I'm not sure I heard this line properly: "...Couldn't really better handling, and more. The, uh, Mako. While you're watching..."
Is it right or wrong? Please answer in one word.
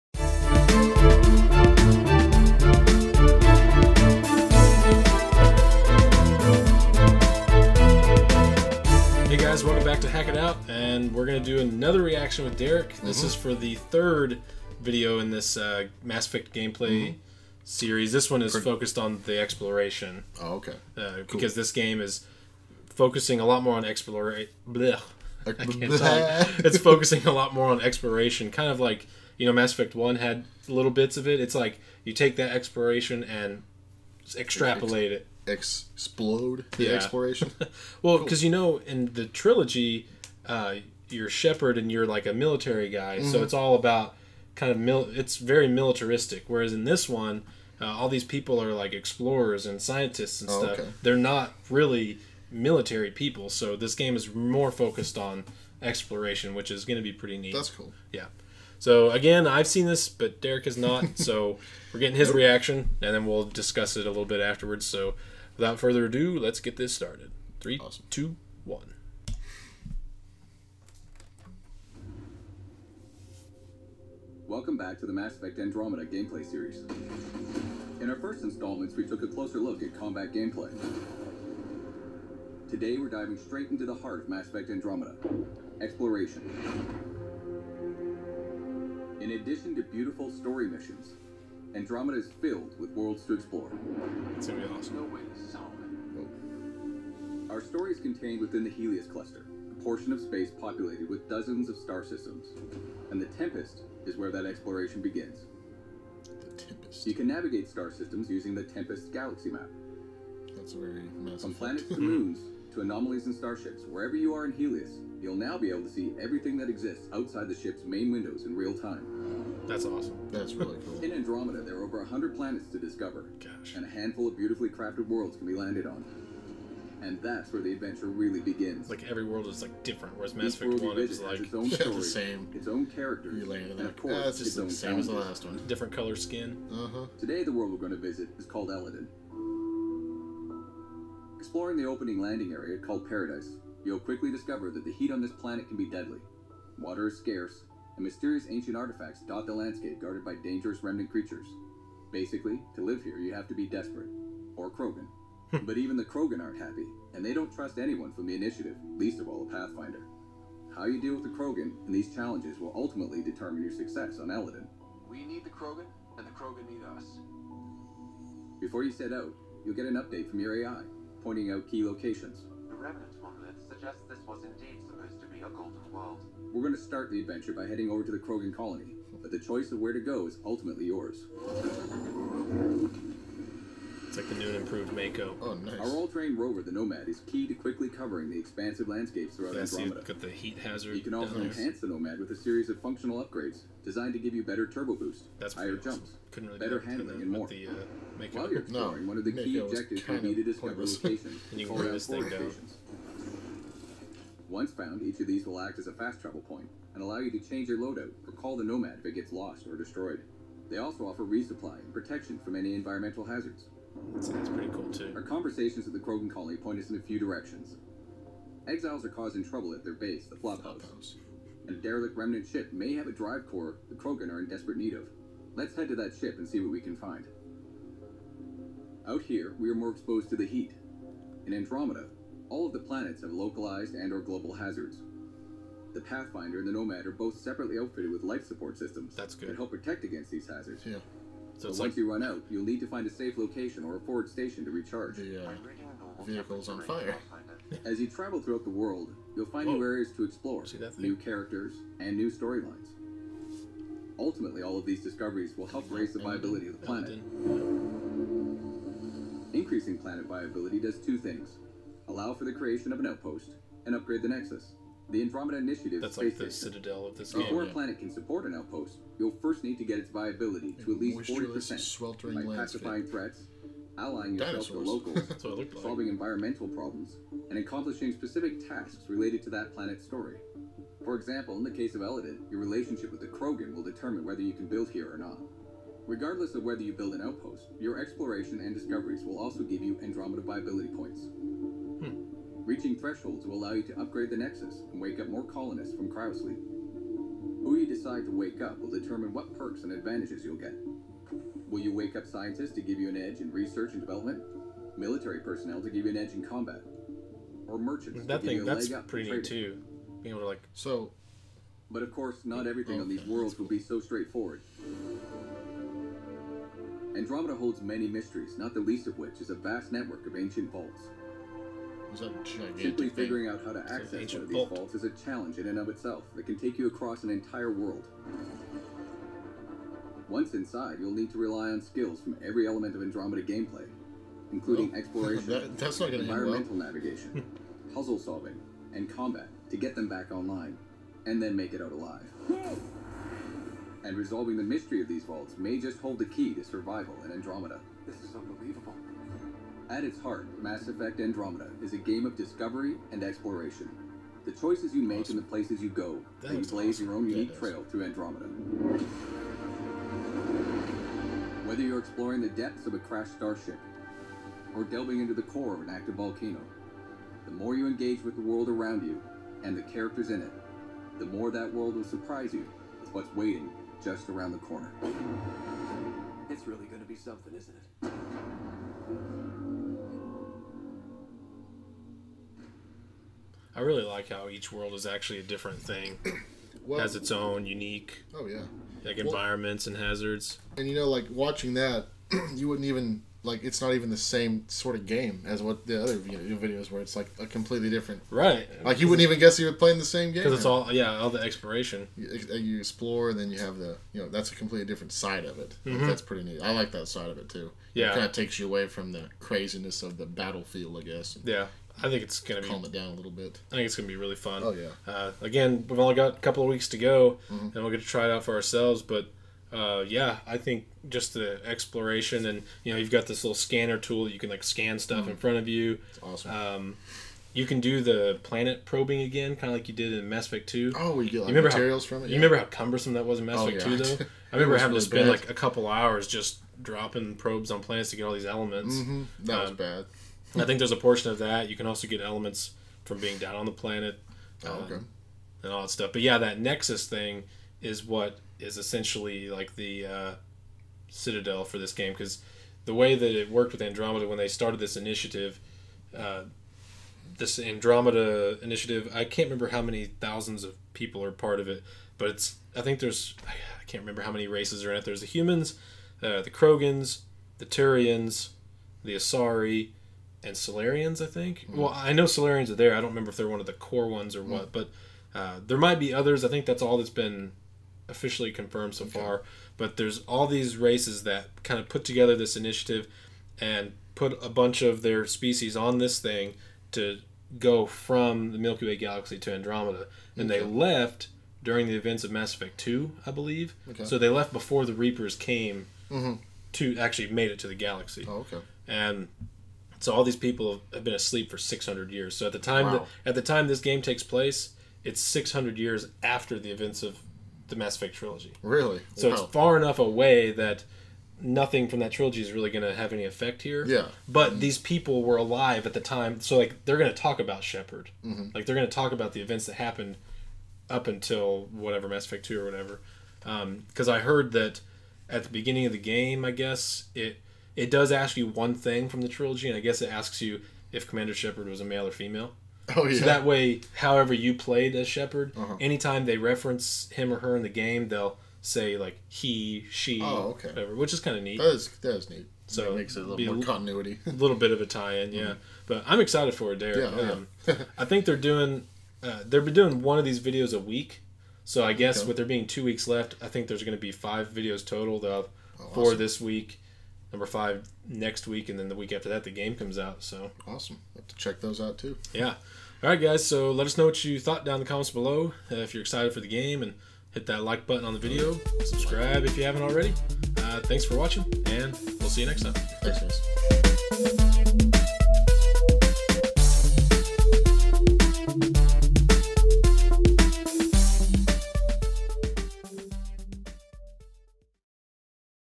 wrong.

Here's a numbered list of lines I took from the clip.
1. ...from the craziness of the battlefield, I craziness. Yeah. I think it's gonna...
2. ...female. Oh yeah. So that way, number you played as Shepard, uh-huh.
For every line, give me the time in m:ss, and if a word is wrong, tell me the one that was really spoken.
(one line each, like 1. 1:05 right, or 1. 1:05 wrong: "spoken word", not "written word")
1. 6:48 wrong: "guess", not "craziness"
2. 8:52 wrong: "however", not "number".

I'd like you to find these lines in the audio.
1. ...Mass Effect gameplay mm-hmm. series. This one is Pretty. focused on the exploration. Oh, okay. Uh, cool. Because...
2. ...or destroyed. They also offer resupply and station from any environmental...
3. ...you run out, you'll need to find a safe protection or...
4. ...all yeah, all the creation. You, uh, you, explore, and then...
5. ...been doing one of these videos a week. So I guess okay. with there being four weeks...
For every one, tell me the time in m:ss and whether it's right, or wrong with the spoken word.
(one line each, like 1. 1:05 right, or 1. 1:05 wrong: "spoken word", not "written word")
1. 0:16 right
2. 3:29 wrong: "protection", not "station"
3. 4:01 wrong: "location", not "protection"
4. 6:40 wrong: "exploration", not "creation"
5. 9:09 wrong: "two", not "four".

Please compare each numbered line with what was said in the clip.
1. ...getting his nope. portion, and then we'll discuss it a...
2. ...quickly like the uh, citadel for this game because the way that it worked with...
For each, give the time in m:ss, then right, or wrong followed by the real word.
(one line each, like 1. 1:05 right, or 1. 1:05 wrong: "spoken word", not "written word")
1. 1:02 wrong: "reaction", not "portion"
2. 7:28 wrong: "essentially", not "quickly".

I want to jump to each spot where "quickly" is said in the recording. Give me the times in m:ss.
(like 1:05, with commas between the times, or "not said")
2:23, 3:07.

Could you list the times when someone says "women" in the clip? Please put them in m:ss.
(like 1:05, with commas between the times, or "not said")
not said.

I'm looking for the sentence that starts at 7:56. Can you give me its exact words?
I think that's all that's been officially confirmed so okay.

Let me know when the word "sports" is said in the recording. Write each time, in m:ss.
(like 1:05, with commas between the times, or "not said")
not said.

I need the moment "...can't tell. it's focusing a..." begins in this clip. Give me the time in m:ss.
0:25.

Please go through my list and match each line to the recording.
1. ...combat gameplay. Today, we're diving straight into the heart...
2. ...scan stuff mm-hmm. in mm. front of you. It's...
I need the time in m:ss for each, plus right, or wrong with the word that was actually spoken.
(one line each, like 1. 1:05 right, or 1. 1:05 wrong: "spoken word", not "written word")
1. 1:19 right
2. 7:04 right.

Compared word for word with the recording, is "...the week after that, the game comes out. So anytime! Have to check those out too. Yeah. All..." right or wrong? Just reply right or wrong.
wrong.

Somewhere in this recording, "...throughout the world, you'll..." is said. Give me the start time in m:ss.
4:08.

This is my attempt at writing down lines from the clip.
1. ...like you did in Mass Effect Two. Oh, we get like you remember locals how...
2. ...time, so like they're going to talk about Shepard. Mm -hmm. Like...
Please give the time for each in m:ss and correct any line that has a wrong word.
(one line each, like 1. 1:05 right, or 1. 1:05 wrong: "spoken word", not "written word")
1. 7:09 wrong: "materials", not "locals"
2. 8:36 right.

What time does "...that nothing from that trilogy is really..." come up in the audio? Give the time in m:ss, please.
8:30.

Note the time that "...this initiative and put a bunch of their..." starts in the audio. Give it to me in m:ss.
8:02.